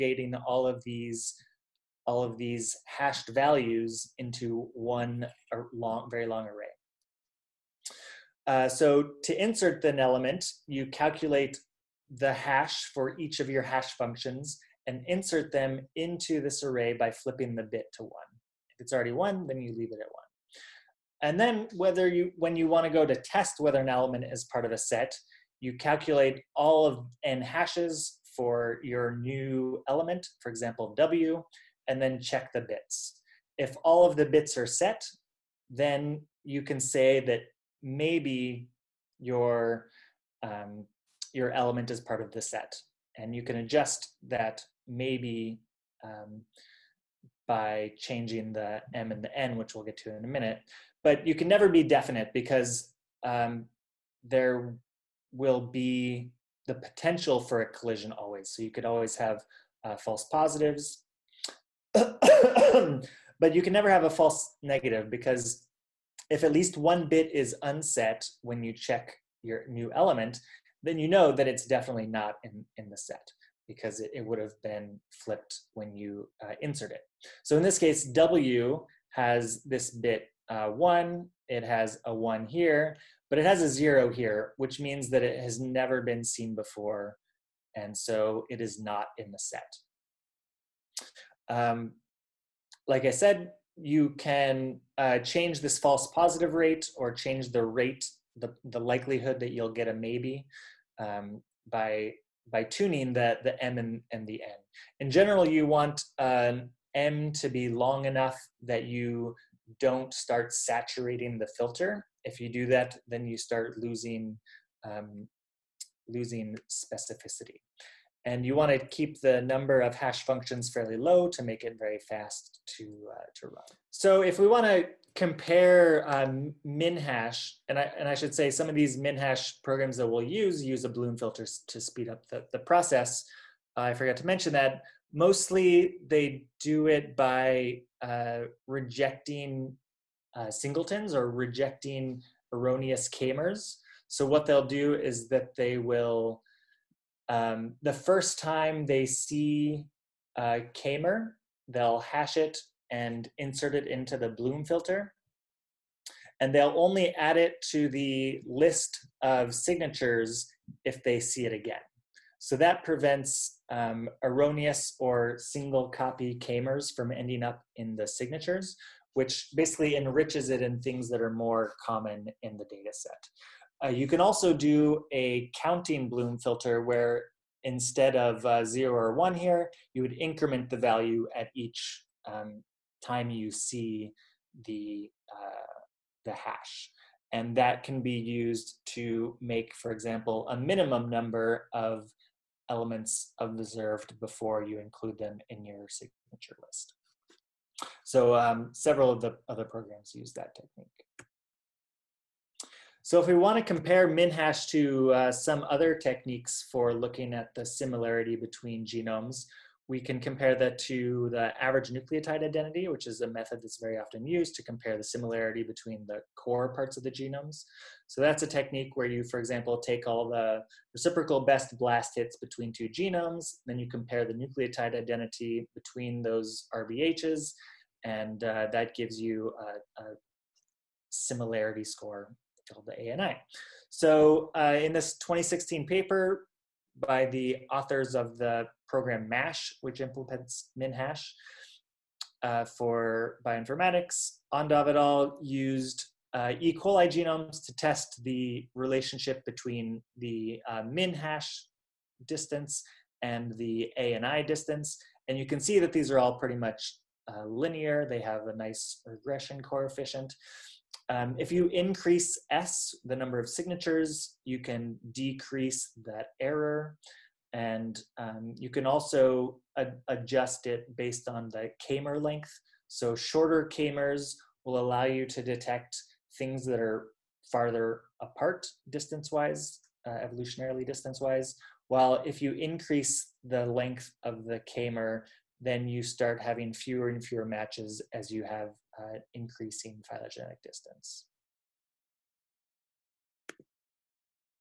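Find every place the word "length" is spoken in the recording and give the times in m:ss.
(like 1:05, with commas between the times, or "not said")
4:32, 4:43.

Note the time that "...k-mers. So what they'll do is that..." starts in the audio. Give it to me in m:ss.
2:23.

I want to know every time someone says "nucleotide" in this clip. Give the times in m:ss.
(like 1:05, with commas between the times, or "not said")
3:31, 3:44.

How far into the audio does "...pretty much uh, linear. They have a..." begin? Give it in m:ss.
4:16.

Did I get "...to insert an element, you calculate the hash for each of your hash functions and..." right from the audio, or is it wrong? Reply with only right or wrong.
right.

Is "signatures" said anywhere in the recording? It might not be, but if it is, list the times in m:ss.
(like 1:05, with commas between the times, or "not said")
2:39, 2:48, 3:15, 4:23.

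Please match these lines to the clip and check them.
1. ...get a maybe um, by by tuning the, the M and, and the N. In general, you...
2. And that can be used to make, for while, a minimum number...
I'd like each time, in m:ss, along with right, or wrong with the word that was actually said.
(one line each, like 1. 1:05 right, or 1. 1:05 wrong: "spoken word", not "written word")
1. 1:39 right
2. 3:07 wrong: "example", not "while".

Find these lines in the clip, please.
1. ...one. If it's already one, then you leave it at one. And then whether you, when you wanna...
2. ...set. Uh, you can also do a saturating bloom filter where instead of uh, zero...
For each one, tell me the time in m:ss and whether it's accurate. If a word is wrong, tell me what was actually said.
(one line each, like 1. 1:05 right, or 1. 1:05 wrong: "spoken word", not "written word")
1. 0:18 right
2. 2:52 wrong: "counting", not "saturating".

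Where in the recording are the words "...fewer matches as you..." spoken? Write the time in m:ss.
4:47.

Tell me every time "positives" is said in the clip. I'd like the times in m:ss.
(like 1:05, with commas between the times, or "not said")
1:00, 1:36.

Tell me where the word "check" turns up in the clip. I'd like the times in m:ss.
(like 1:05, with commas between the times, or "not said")
0:32, 1:08.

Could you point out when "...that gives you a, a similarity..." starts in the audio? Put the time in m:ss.
3:48.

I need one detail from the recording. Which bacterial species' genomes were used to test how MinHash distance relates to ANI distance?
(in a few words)
E. coli.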